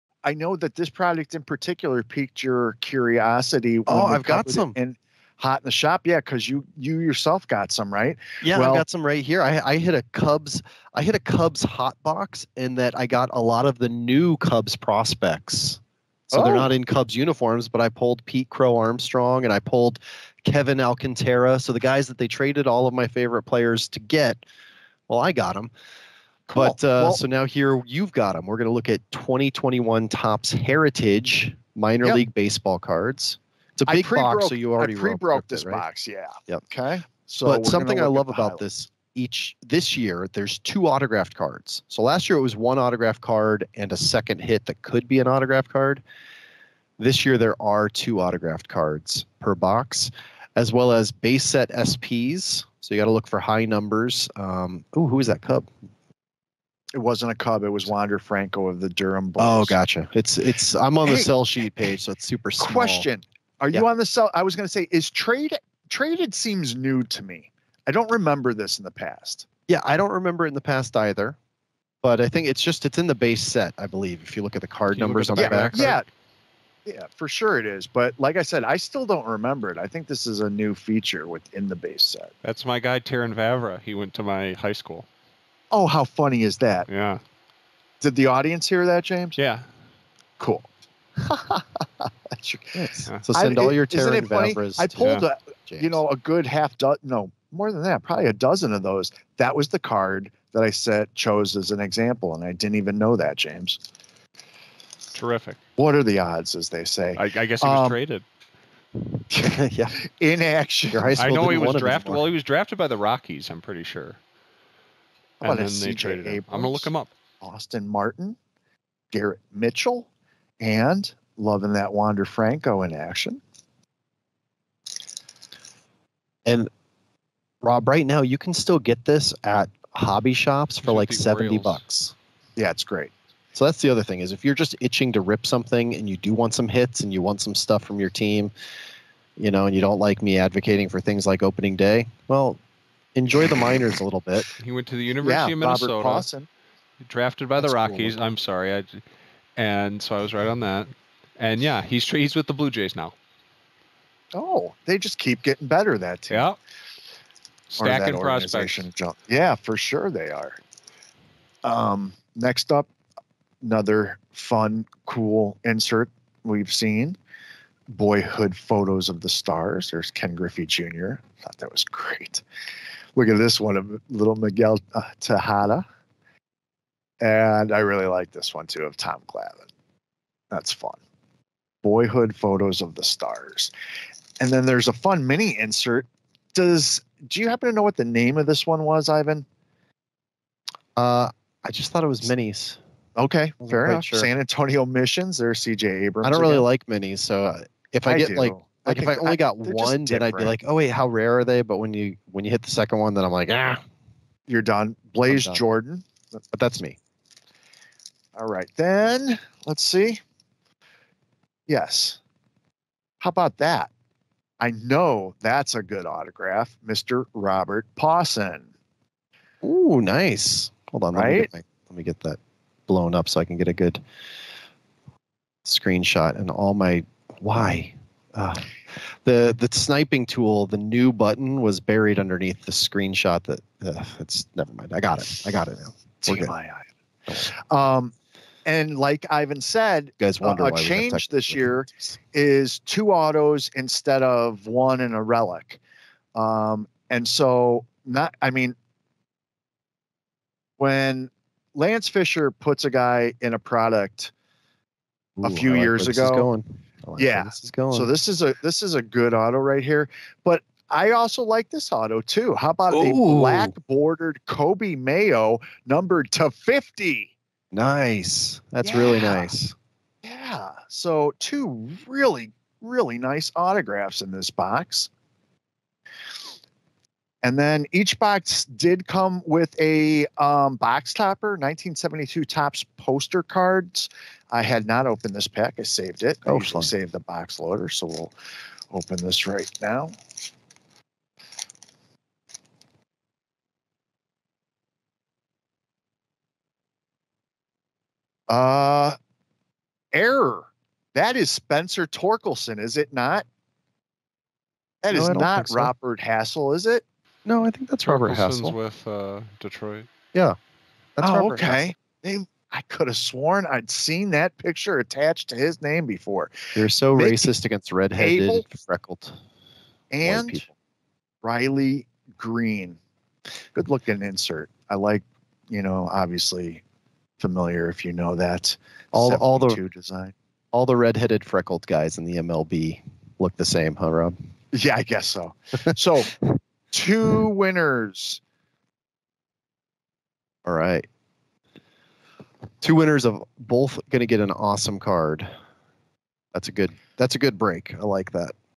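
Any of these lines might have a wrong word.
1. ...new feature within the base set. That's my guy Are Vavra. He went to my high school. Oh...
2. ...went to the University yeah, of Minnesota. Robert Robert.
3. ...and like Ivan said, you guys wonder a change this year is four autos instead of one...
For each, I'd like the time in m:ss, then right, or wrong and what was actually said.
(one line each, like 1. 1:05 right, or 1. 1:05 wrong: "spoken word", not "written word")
1. 1:20 wrong: "Terrin", not "Are"
2. 2:24 wrong: "Pawson", not "Robert"
3. 3:58 wrong: "two", not "four".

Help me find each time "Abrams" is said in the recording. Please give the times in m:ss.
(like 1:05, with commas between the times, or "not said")
1:56, 3:15.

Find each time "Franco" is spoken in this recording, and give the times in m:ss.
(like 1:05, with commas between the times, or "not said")
0:58, 2:02.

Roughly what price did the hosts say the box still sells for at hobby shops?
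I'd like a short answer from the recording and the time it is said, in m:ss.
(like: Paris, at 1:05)
$70, at 2:11.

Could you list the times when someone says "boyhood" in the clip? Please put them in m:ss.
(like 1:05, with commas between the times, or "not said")
2:47, 3:01.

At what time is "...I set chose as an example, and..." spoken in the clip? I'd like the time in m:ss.
1:40.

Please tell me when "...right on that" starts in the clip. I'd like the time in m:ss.
2:30.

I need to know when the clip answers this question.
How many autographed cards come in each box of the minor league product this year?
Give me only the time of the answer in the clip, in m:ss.
0:47.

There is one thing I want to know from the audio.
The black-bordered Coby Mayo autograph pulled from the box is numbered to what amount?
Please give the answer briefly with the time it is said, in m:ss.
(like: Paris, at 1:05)
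50, at 4:26.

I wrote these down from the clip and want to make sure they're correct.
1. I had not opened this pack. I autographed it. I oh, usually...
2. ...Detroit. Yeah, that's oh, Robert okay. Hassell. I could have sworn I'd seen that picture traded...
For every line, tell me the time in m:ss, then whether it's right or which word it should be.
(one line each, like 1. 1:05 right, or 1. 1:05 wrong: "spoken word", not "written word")
1. 4:44 wrong: "saved", not "autographed"
2. 5:09 wrong: "attached", not "traded".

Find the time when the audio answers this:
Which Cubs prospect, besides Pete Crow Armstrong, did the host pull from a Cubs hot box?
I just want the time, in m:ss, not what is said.
0:20.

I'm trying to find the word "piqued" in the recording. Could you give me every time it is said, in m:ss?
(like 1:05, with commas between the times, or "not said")
0:02.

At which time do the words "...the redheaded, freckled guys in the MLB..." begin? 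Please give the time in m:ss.
5:30.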